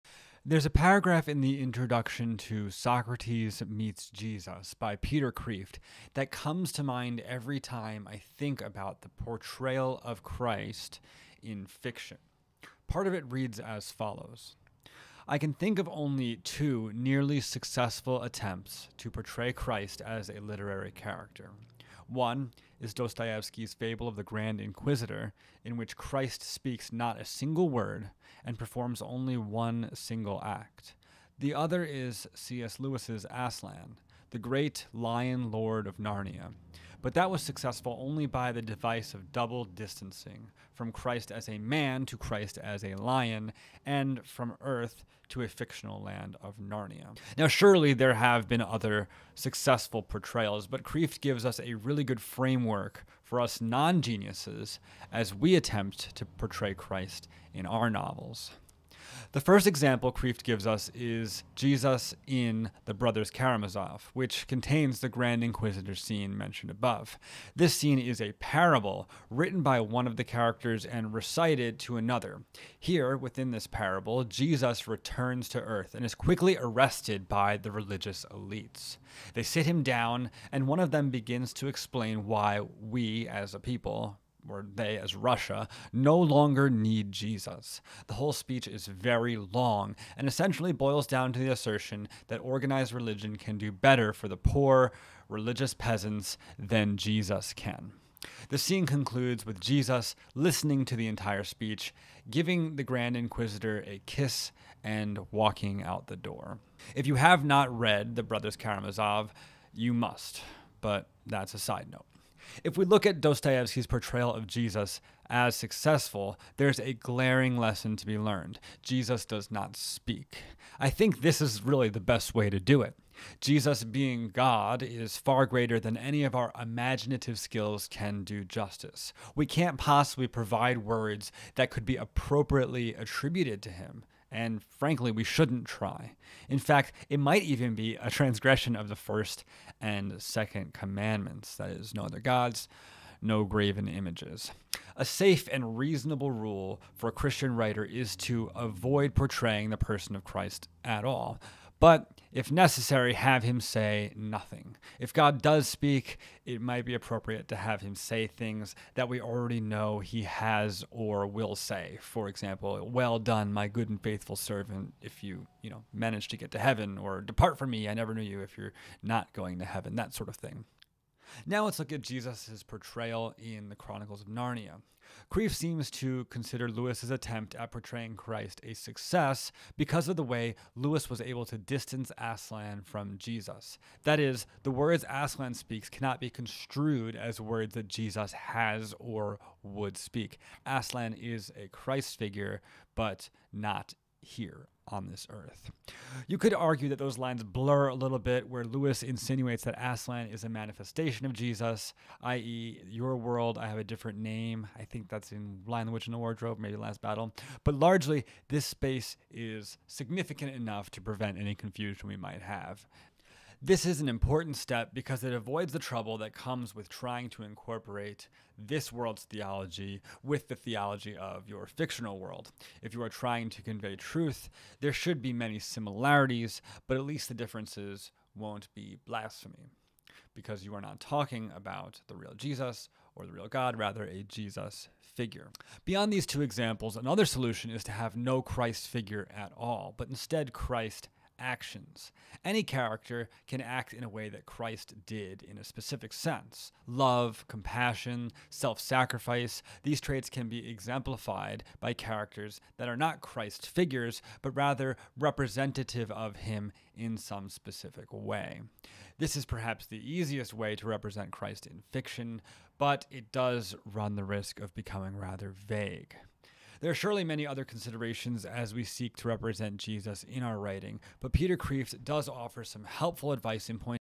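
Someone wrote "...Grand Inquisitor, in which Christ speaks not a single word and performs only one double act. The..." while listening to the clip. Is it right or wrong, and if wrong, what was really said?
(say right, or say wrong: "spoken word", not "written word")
wrong: "single", not "double".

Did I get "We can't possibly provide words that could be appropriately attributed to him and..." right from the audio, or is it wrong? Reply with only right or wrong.
right.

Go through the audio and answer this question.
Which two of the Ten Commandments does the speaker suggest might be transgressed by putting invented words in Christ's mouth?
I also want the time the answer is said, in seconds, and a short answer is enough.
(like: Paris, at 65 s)
First and second, at 138 s.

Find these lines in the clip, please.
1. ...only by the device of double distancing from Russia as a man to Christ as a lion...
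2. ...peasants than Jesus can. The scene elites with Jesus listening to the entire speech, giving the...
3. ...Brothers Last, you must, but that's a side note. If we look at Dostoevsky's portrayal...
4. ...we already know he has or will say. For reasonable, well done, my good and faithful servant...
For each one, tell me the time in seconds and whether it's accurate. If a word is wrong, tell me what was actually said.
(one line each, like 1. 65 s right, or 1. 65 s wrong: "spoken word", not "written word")
1. 37 s wrong: "Christ", not "Russia"
2. 95 s wrong: "concludes", not "elites"
3. 108 s wrong: "Karamazov", not "Last"
4. 159 s wrong: "example", not "reasonable".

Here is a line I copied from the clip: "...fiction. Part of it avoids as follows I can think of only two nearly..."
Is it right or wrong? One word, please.
wrong.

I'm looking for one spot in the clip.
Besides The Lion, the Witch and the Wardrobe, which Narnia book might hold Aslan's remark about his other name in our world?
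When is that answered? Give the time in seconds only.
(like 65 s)
206 s.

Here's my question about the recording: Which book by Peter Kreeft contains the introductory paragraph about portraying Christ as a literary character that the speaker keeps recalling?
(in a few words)
Socrates Meets Jesus.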